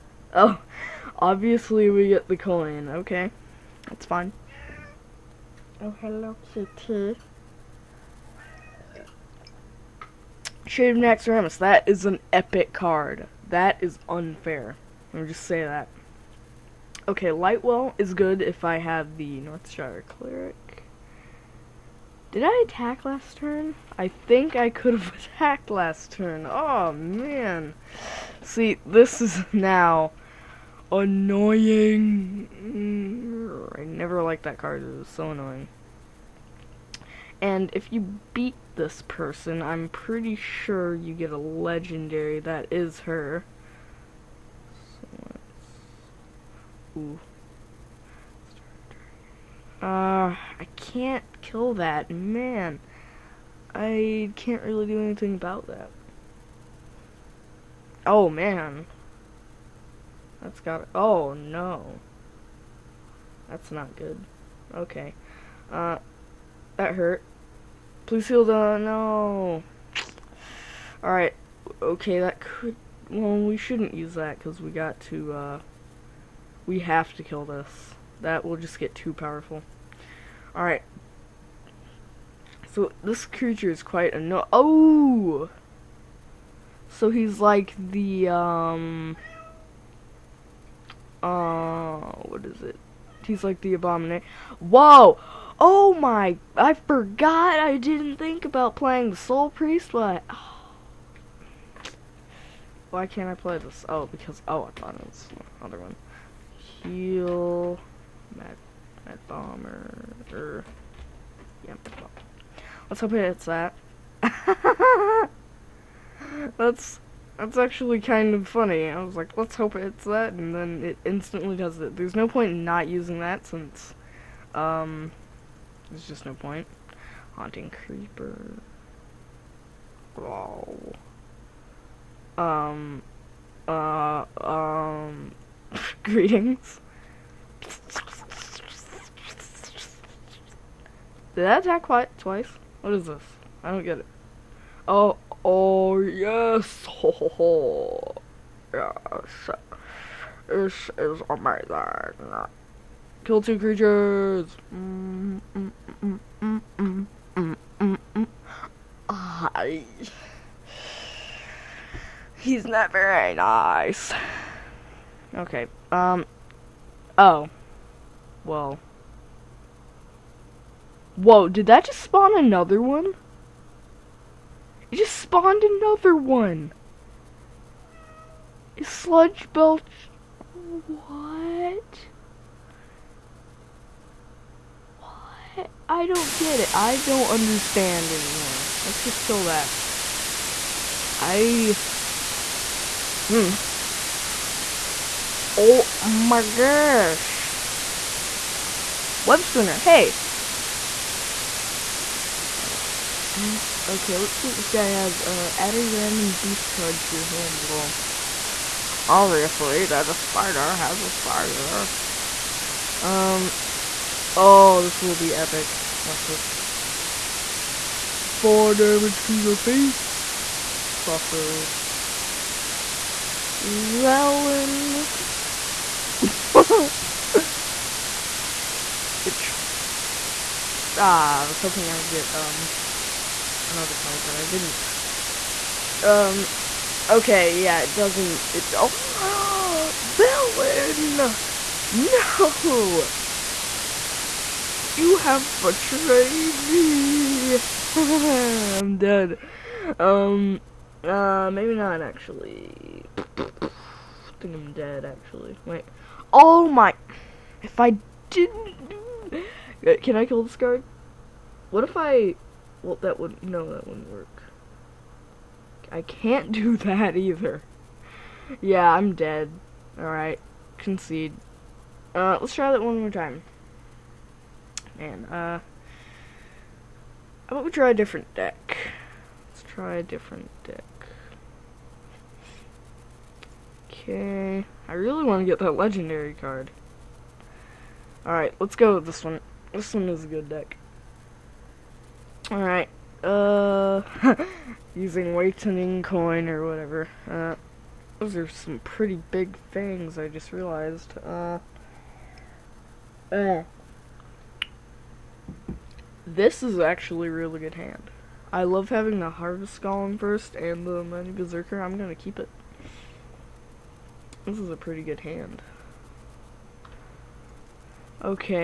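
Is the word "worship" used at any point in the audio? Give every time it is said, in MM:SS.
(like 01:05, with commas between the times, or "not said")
not said.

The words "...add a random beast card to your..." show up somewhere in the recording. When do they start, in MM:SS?
03:25.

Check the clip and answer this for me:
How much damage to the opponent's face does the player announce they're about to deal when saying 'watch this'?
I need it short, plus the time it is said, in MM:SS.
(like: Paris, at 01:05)
4, at 03:38.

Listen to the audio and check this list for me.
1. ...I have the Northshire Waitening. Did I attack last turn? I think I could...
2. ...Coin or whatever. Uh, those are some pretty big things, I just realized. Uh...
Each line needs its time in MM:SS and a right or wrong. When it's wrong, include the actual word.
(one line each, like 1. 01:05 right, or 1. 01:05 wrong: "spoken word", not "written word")
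1. 00:18 wrong: "Cleric", not "Waitening"
2. 04:56 right.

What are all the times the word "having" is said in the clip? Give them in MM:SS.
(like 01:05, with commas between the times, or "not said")
05:08.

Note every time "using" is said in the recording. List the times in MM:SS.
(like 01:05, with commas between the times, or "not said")
02:02, 04:54.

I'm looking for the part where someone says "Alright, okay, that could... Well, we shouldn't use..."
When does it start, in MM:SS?
01:11.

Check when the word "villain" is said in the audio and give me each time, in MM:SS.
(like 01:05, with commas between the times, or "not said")
03:43, 04:00.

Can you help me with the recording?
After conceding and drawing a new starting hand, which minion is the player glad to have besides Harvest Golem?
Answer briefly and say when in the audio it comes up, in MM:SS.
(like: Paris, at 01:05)
Amani Berserker, at 05:10.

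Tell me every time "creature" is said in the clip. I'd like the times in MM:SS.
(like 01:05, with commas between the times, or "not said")
01:23, 02:33.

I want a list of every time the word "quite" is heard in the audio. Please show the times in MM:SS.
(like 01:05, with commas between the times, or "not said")
01:23, 02:21.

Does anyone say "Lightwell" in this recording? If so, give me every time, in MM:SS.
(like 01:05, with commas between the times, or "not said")
00:17.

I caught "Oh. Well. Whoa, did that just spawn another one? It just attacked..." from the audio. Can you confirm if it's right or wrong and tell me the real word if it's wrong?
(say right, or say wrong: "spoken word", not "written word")
wrong: "spawned", not "attacked".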